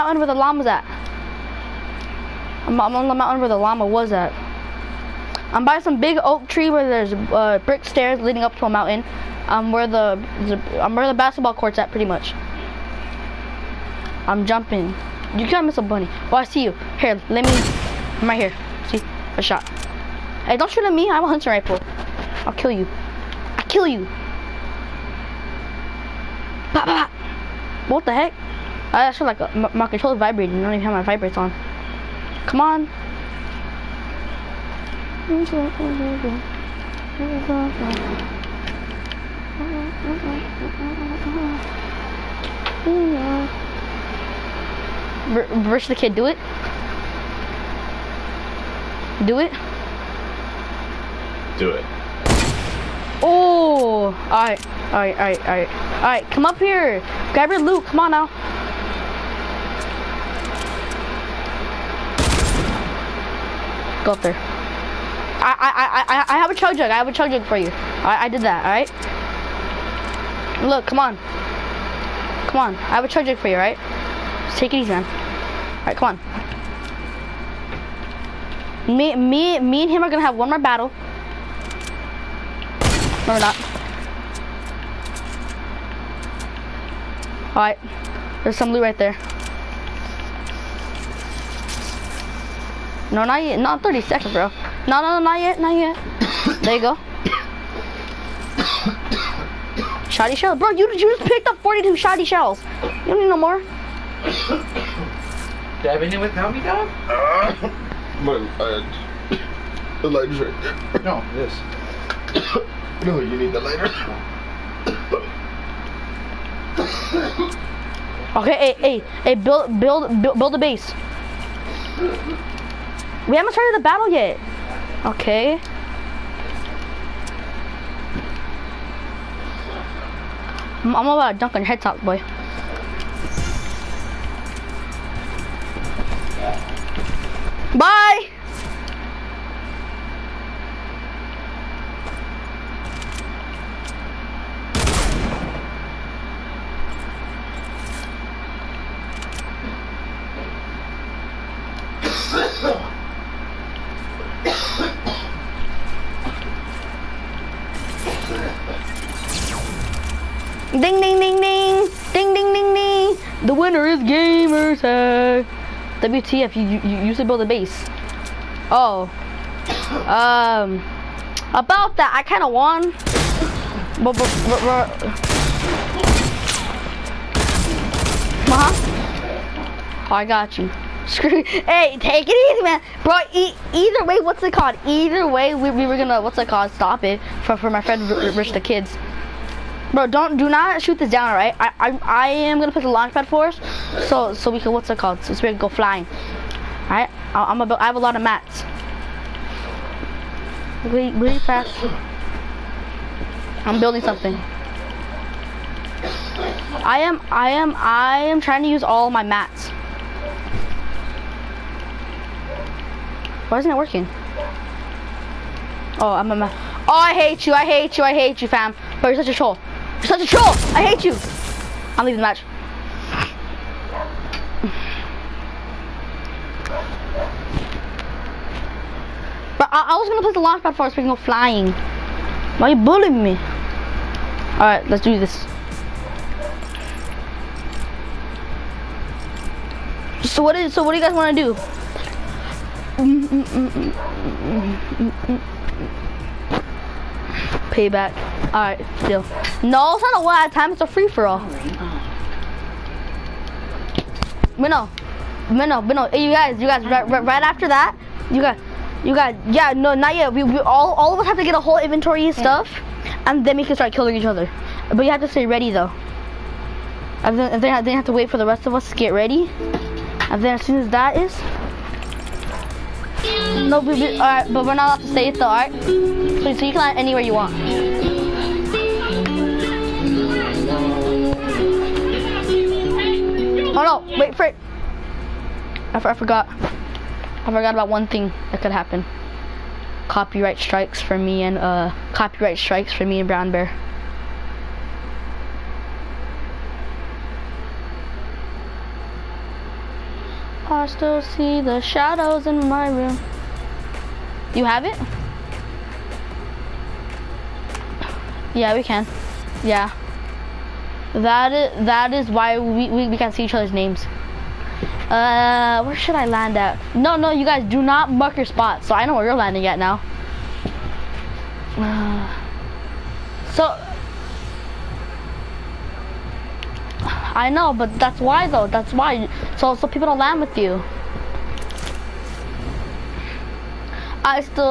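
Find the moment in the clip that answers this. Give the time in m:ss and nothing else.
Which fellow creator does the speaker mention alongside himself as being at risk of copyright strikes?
4:53.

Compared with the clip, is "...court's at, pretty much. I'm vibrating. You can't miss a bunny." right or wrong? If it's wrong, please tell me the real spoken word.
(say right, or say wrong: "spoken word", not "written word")
wrong: "jumping", not "vibrating".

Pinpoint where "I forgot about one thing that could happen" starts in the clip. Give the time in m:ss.
4:46.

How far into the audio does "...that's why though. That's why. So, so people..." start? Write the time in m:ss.
5:27.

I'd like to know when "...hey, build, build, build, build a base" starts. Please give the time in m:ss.
1:59.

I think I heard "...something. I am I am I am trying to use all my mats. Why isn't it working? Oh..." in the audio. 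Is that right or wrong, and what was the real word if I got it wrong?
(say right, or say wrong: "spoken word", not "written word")
right.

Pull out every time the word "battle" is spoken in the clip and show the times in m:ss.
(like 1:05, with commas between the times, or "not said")
1:20, 2:03.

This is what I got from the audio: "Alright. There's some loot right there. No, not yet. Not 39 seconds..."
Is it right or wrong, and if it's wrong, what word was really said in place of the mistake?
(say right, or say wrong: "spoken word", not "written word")
wrong: "30", not "39".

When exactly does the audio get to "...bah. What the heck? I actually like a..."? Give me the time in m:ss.
0:27.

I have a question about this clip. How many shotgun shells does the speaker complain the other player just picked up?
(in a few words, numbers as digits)
42.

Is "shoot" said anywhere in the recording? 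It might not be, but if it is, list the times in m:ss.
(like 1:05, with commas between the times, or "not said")
0:20, 3:10.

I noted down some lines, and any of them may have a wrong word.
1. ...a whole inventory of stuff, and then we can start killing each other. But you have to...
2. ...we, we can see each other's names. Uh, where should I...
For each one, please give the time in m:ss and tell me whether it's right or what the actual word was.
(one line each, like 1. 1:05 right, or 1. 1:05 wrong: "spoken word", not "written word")
1. 4:21 right
2. 5:12 right.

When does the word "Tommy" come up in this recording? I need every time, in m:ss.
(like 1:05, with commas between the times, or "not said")
1:46.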